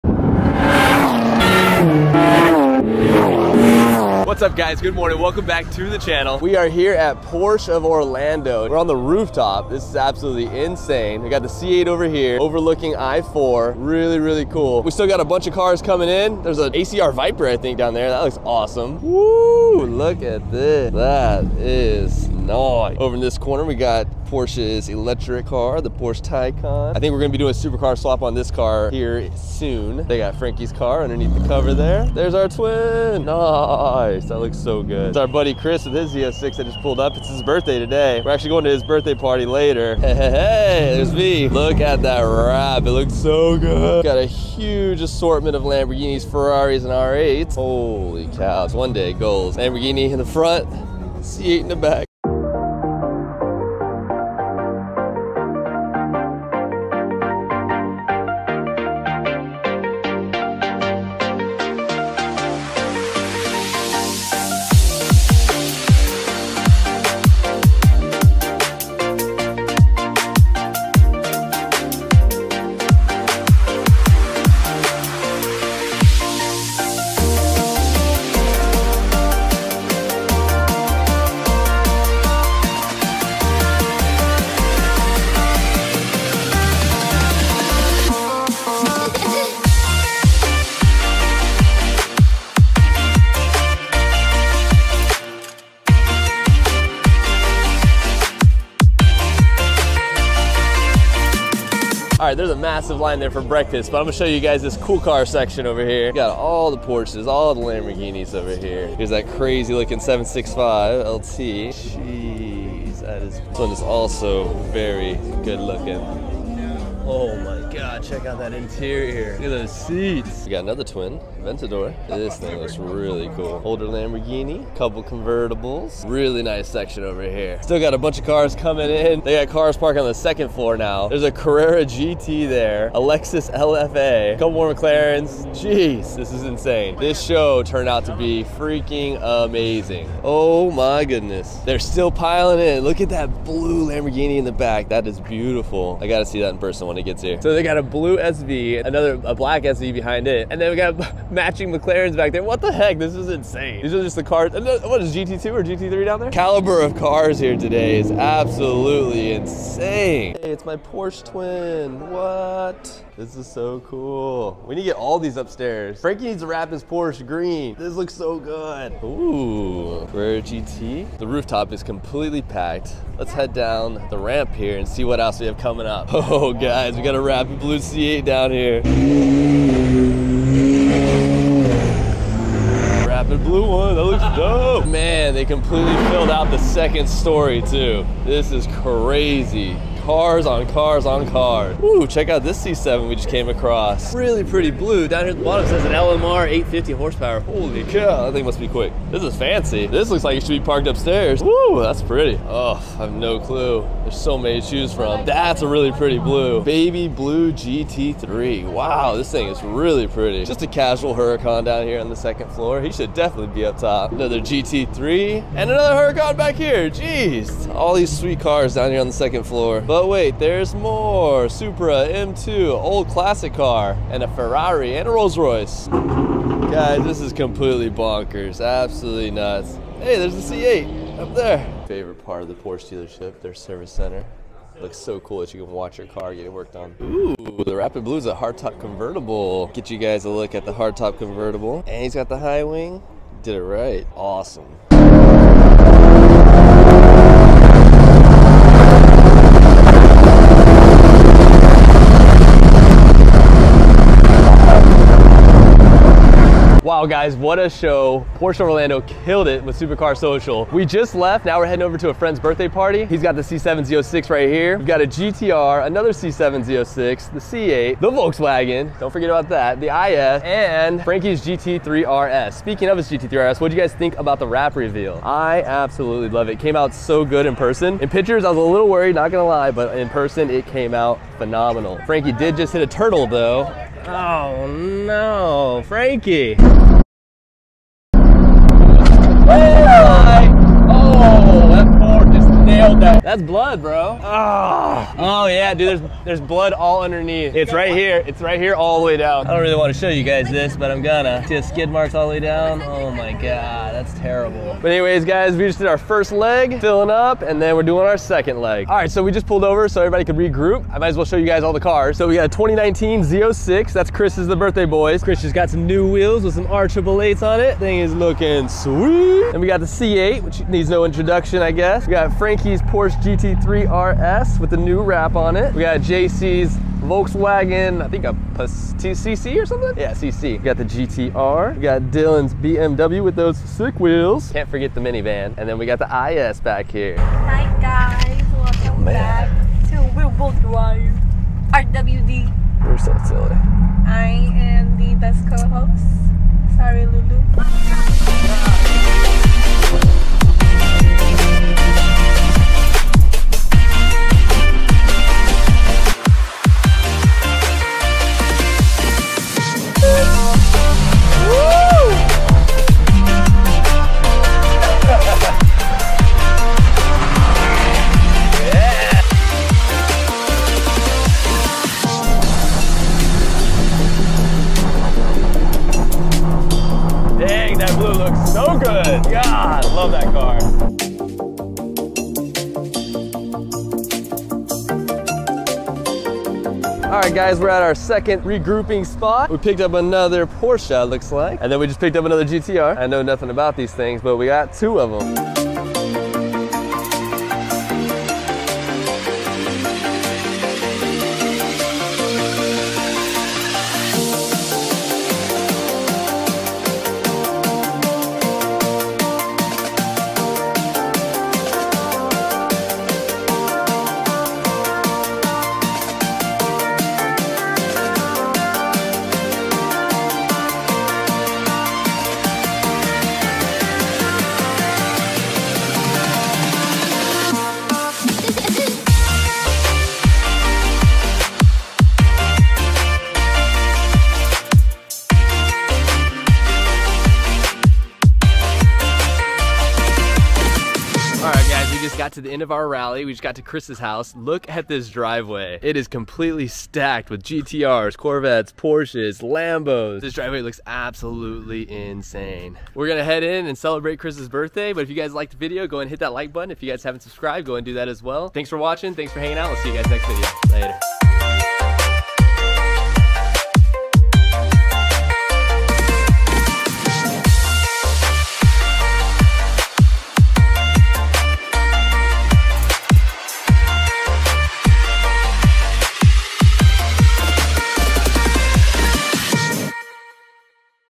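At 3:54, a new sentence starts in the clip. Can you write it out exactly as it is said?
Looks so cool that you can watch your car it worked on.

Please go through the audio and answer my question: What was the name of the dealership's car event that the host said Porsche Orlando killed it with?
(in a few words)
Supercar Social.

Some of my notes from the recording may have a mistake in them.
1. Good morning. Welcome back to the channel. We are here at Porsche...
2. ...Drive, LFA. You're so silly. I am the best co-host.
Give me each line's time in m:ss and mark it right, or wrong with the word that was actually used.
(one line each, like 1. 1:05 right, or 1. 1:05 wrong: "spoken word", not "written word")
1. 0:04 right
2. 5:40 wrong: "RWD", not "LFA".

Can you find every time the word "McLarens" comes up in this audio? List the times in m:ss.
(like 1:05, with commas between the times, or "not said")
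2:14, 2:31.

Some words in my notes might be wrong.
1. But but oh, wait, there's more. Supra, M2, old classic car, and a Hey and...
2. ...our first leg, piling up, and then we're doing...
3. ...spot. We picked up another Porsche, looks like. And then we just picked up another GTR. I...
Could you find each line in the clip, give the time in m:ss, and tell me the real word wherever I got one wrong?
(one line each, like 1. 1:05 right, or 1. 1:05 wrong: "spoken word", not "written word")
1. 3:39 wrong: "Ferrari", not "Hey"
2. 5:05 wrong: "filling", not "piling"
3. 6:29 right.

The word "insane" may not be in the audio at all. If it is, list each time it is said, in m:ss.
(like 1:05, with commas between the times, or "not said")
0:10, 2:16, 2:33, 2:39, 7:31.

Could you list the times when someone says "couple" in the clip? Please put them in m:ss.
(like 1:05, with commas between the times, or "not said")
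2:04, 2:14.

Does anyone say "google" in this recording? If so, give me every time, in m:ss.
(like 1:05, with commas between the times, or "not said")
not said.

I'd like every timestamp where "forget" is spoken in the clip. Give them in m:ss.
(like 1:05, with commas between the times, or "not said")
4:29, 5:34.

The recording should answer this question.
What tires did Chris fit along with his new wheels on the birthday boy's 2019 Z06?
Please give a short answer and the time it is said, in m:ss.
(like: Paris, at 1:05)
R888s, at 5:16.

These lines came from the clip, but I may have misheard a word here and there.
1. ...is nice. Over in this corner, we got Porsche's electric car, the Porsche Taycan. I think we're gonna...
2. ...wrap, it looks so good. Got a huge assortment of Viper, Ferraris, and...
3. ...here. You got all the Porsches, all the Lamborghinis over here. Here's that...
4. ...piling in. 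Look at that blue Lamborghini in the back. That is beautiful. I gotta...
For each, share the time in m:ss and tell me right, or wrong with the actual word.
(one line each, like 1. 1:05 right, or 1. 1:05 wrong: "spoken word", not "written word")
1. 0:21 right
2. 0:42 wrong: "Lamborghinis", not "Viper"
3. 1:45 right
4. 2:22 right.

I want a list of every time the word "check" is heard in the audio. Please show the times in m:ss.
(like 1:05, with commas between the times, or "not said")
1:58, 3:12.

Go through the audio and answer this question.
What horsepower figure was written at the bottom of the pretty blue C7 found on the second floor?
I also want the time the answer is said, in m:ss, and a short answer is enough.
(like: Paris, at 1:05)
850, at 3:16.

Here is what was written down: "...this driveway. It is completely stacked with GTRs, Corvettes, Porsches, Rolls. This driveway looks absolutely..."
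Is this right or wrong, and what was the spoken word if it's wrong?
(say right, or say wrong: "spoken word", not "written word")
wrong: "Lambos", not "Rolls".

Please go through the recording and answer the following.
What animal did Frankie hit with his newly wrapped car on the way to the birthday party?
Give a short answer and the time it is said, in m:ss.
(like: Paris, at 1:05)
turtle, at 4:42.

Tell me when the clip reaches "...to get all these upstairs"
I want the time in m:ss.
2:44.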